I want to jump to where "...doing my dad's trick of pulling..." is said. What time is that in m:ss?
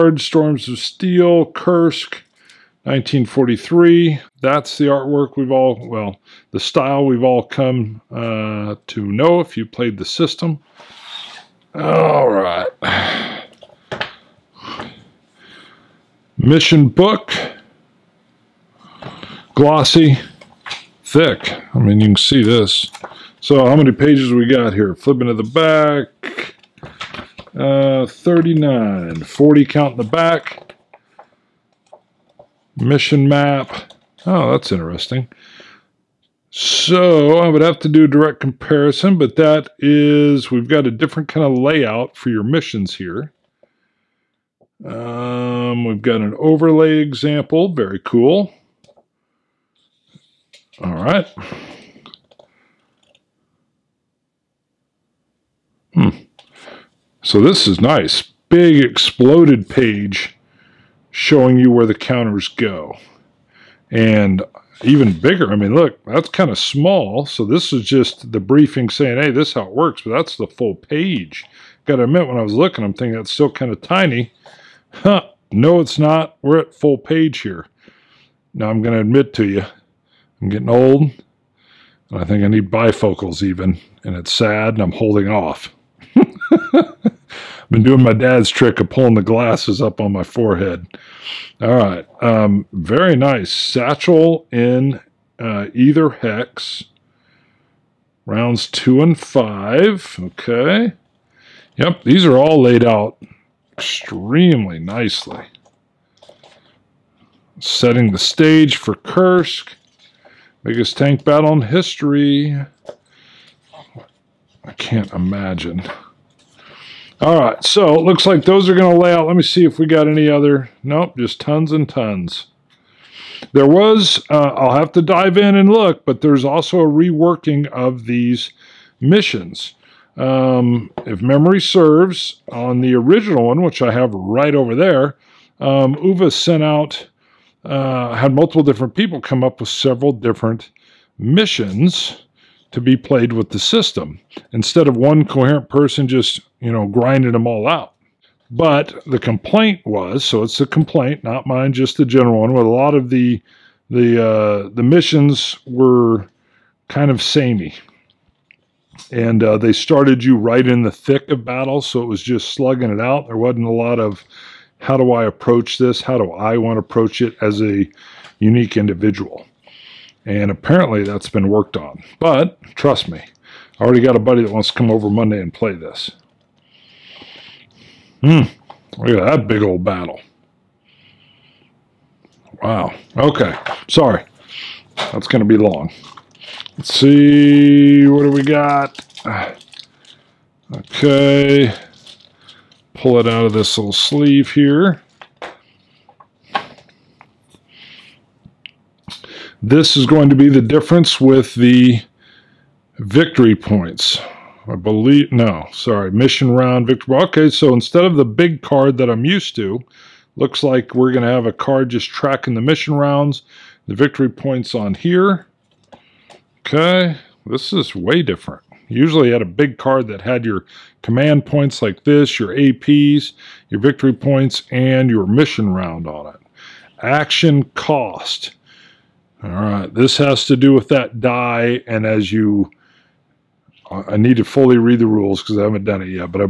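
1:27.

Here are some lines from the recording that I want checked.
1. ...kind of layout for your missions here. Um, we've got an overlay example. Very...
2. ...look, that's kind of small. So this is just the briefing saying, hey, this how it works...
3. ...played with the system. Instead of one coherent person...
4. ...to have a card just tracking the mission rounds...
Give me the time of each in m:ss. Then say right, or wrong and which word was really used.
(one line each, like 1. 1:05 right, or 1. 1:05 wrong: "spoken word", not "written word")
1. 0:41 right
2. 1:05 right
3. 2:22 right
4. 3:31 right.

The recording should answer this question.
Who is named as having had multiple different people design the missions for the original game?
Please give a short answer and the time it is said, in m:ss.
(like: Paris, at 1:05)
Uwe, at 2:15.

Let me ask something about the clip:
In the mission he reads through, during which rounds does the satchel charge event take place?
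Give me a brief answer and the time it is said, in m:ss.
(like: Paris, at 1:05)
Rounds 2 and 5, at 1:38.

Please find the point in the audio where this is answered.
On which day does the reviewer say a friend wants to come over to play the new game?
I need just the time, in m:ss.
2:55.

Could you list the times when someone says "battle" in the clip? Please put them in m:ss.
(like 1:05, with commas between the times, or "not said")
1:51, 2:41, 2:59.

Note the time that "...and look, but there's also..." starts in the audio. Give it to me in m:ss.
2:05.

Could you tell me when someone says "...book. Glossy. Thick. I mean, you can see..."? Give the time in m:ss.
0:16.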